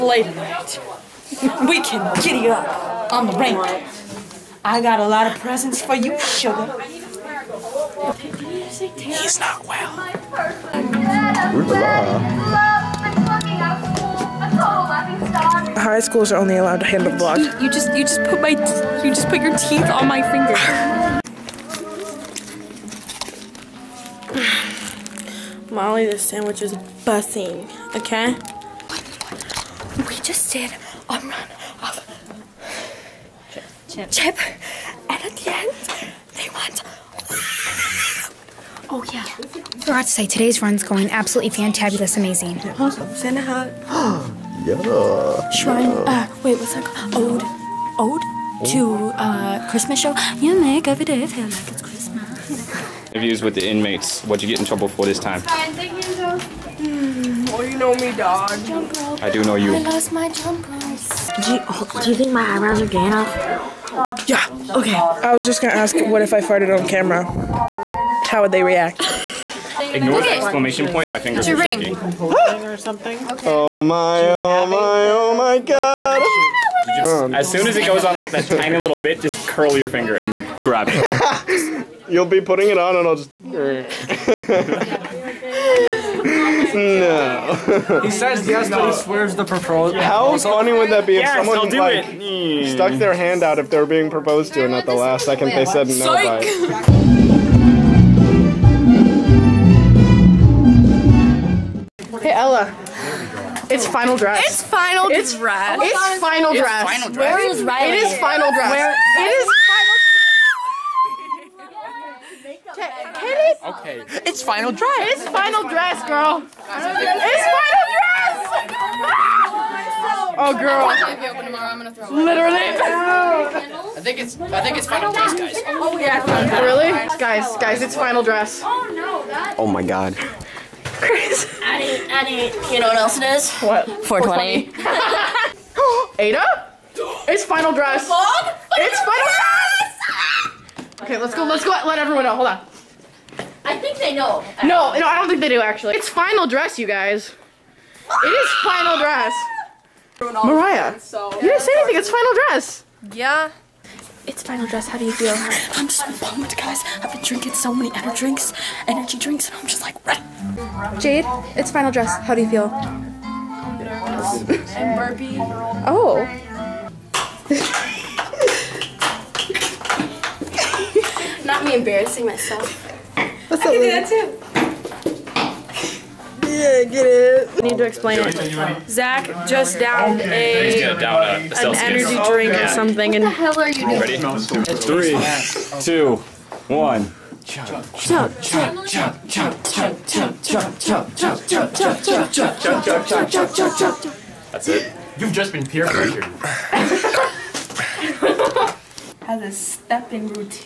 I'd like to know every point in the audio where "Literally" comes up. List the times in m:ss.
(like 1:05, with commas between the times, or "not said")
2:02.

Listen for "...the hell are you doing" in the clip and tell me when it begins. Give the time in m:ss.
3:03.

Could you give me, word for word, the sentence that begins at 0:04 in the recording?
I got a lot of presents for you, sugar.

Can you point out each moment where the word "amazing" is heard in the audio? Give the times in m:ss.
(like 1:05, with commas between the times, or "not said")
0:42.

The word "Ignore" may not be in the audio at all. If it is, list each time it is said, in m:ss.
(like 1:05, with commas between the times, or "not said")
1:09.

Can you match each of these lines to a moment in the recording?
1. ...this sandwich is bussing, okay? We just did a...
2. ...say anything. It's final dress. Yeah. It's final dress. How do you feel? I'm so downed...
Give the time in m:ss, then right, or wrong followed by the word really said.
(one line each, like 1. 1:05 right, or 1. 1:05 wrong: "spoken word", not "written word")
1. 0:26 right
2. 2:31 wrong: "pumped", not "downed".